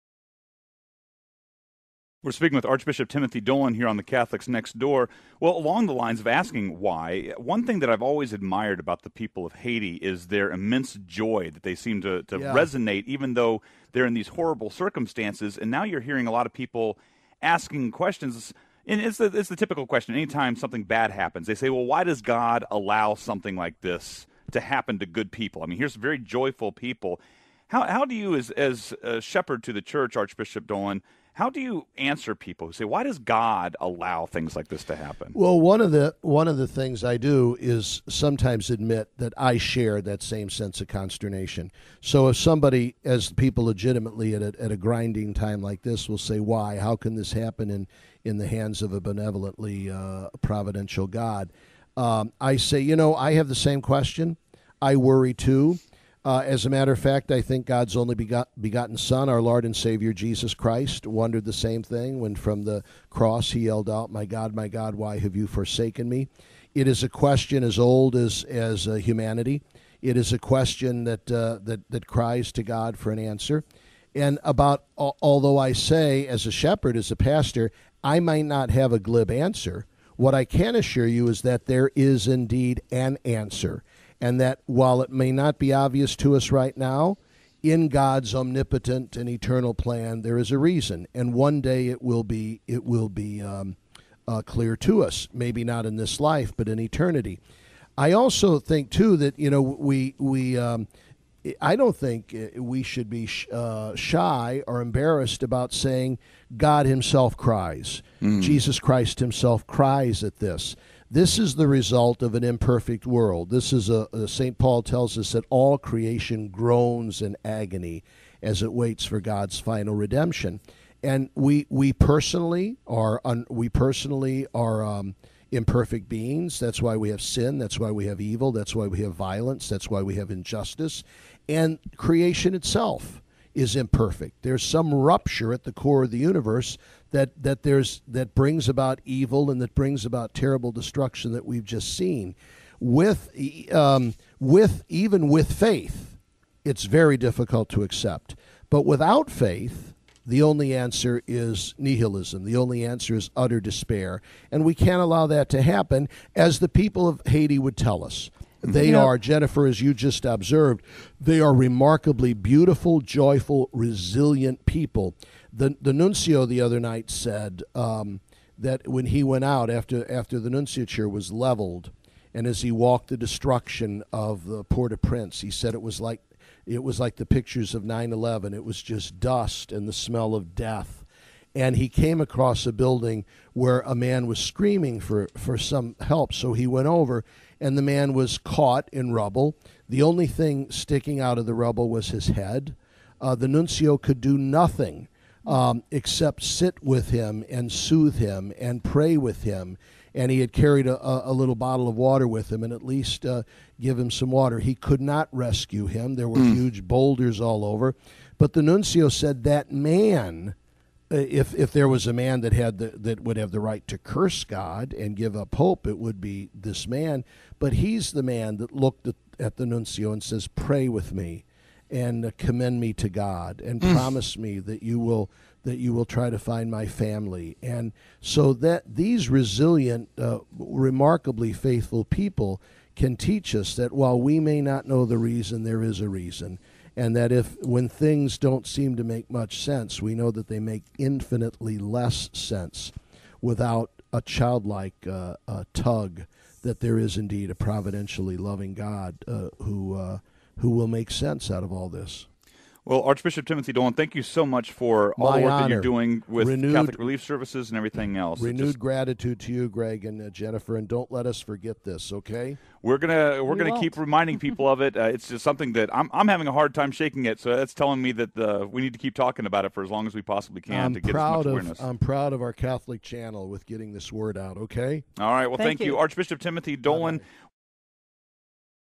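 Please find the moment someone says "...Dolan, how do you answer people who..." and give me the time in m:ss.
0:30.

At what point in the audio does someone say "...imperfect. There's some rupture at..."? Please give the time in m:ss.
2:13.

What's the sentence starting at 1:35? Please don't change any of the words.
Maybe not in this life, but in eternity.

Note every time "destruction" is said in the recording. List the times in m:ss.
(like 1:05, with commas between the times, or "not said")
2:20, 2:53.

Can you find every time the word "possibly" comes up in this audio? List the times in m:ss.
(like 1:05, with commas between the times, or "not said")
4:30.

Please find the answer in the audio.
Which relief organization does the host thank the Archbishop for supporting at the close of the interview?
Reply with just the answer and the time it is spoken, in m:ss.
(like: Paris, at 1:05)
Catholic Relief Services, at 4:16.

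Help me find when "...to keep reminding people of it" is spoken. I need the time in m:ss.
4:23.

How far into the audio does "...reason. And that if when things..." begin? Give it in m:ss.
3:56.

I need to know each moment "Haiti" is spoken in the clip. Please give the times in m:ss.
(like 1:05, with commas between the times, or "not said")
0:09, 2:37.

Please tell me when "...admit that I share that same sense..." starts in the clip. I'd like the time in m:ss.
0:38.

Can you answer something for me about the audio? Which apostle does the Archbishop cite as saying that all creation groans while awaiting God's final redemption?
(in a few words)
St. Paul.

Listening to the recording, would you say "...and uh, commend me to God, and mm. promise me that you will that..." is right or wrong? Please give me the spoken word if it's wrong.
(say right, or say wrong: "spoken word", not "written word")
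right.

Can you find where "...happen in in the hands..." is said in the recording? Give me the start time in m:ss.
0:47.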